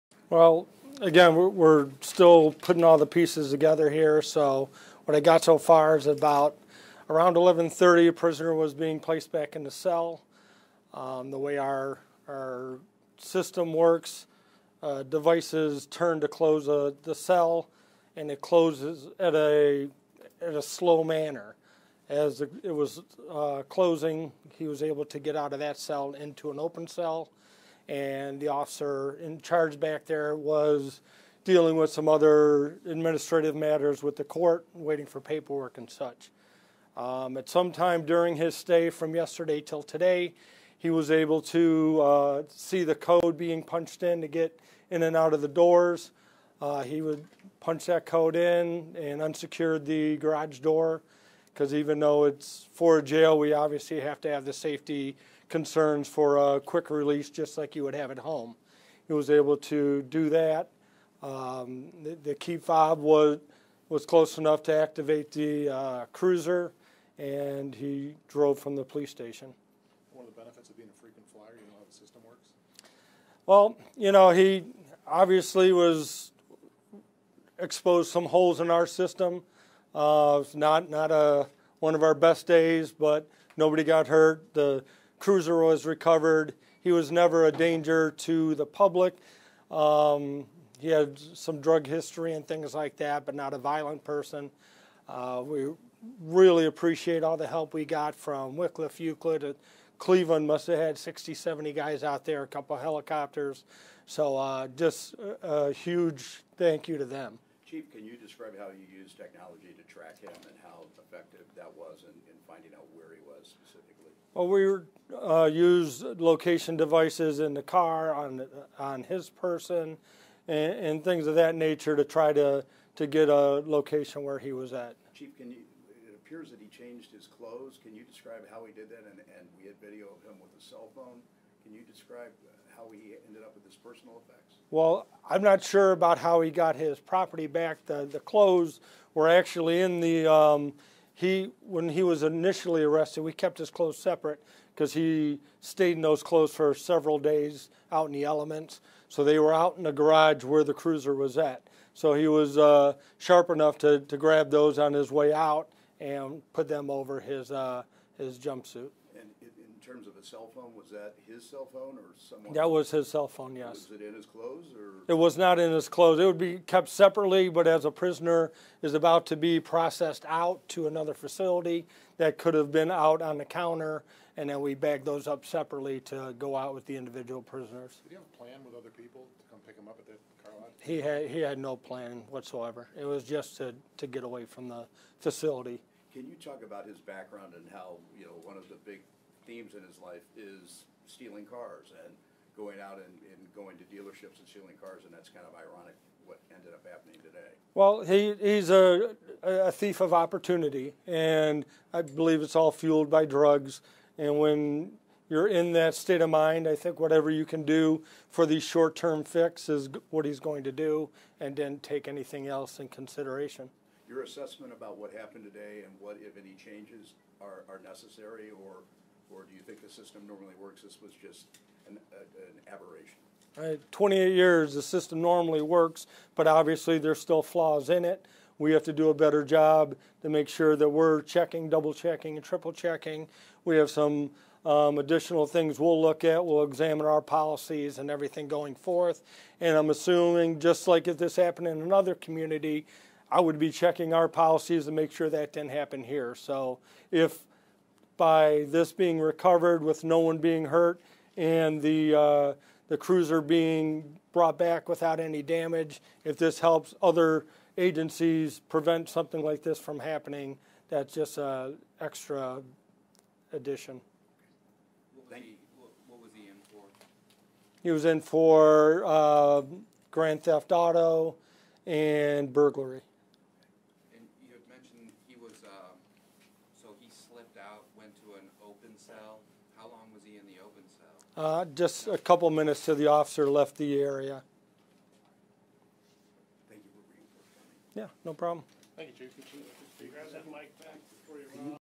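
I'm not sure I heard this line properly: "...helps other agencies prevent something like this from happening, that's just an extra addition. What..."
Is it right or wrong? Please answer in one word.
right.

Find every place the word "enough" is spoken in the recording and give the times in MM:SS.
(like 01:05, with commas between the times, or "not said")
01:04, 02:33.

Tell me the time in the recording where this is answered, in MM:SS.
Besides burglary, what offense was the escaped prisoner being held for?
04:30.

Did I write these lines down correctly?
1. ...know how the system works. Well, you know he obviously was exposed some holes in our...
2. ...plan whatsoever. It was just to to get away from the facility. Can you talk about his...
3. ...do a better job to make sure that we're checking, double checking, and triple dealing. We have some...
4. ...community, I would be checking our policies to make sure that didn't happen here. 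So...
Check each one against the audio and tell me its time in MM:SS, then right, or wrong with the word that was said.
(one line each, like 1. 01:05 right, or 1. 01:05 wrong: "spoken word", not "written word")
1. 01:11 right
2. 03:01 right
3. 03:48 wrong: "checking", not "dealing"
4. 04:02 right.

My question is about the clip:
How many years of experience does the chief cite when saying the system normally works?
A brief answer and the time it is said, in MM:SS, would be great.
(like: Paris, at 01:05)
28, at 03:43.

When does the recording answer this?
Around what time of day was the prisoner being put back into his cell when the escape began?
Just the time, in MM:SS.
00:07.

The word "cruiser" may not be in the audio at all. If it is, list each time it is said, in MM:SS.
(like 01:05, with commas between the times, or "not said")
01:06, 01:25, 02:30, 04:12.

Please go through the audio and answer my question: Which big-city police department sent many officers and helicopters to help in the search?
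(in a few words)
Cleveland.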